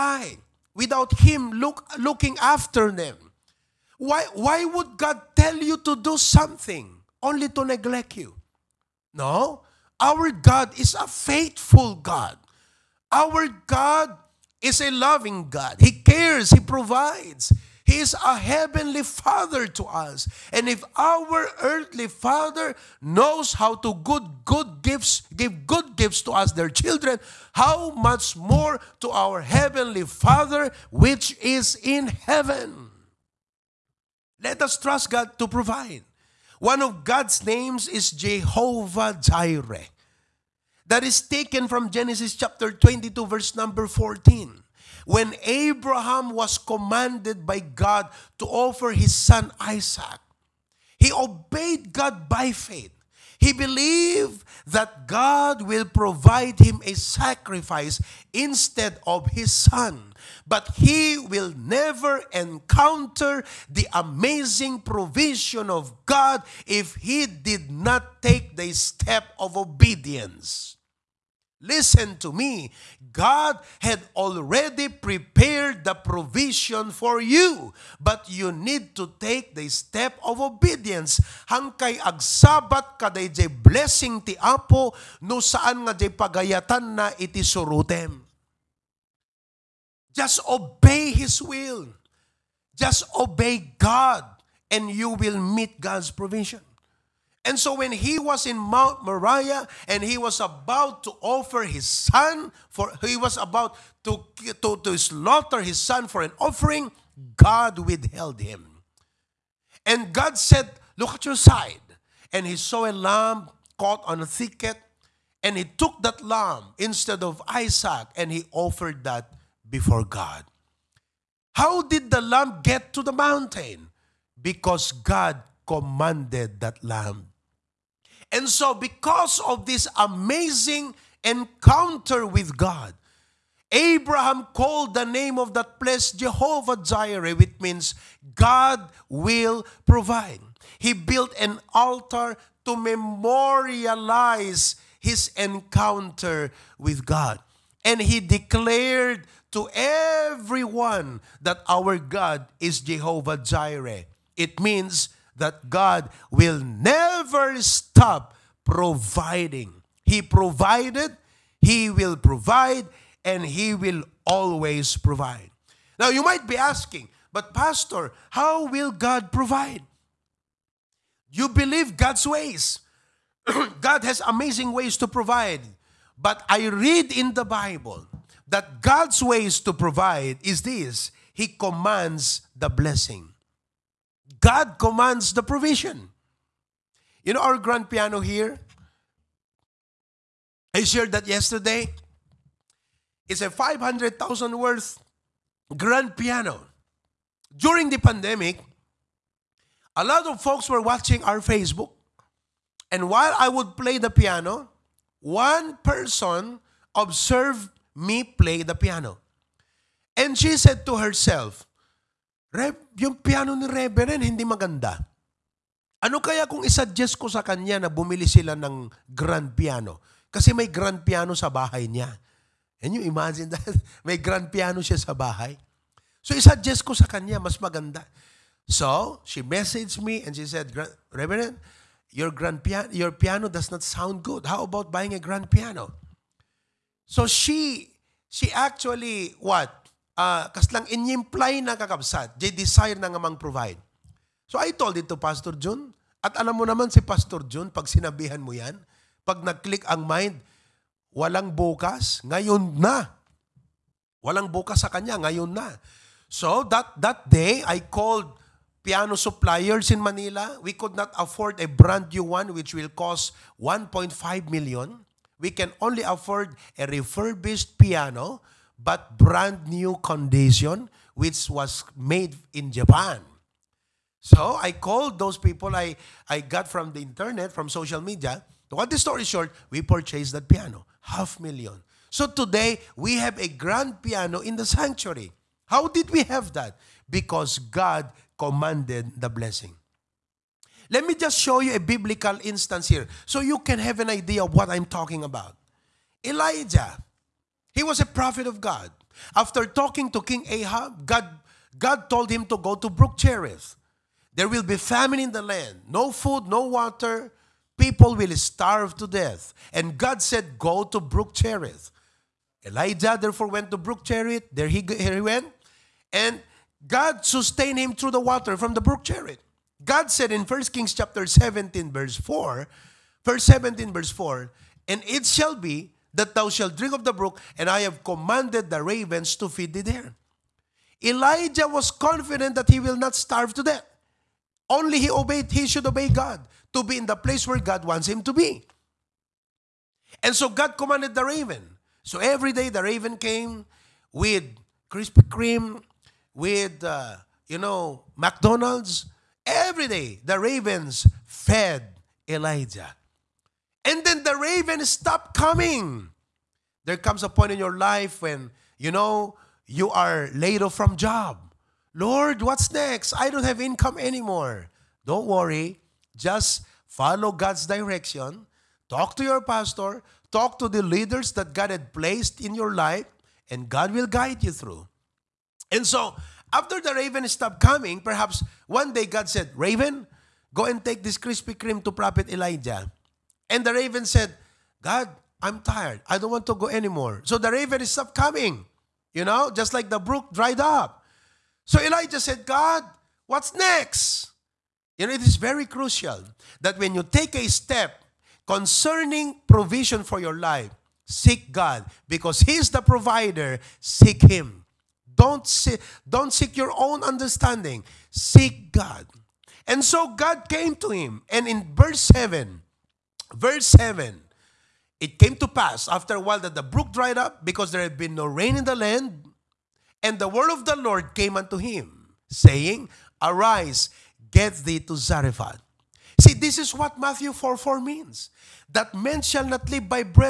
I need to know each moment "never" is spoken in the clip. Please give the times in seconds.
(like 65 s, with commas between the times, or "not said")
61 s, 156 s.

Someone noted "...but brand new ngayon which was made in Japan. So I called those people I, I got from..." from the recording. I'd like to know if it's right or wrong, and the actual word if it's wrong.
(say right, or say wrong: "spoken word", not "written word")
wrong: "condition", not "ngayon".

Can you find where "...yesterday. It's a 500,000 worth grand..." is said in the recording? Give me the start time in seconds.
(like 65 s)
191 s.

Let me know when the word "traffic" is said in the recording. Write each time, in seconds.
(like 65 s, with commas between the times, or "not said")
not said.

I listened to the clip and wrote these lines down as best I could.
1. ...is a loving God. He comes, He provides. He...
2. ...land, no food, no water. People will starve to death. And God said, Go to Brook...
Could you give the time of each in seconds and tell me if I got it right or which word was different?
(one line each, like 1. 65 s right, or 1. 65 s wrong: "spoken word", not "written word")
1. 14 s wrong: "cares", not "comes"
2. 305 s right.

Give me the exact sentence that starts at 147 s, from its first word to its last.
And he declared to everyone that our God is Jehovah Jireh.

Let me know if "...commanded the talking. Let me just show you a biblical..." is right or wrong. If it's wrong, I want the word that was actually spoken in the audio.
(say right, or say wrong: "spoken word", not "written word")
wrong: "blessing", not "talking".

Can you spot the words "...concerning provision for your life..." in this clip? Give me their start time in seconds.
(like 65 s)
398 s.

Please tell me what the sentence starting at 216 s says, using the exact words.
Ano kaya kung isuggest ko sa kanya na bumili sila ng grand piano?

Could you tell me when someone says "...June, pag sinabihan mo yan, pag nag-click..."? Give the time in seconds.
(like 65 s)
247 s.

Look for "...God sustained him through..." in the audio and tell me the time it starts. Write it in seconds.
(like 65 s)
316 s.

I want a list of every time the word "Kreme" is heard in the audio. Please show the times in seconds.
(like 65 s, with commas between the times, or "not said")
345 s, 381 s.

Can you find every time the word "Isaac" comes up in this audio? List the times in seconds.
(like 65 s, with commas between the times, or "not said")
49 s, 117 s.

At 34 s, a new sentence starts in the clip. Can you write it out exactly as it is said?
Let us trust God to provide.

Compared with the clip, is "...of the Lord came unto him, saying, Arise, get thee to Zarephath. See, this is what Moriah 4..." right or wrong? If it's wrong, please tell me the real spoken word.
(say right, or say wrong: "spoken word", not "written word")
wrong: "Matthew", not "Moriah".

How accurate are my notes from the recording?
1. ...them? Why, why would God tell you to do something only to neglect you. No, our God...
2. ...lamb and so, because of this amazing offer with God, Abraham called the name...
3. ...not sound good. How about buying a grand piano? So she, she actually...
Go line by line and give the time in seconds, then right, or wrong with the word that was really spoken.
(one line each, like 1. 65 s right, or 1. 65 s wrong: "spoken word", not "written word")
1. 2 s right
2. 126 s wrong: "encounter", not "offer"
3. 233 s right.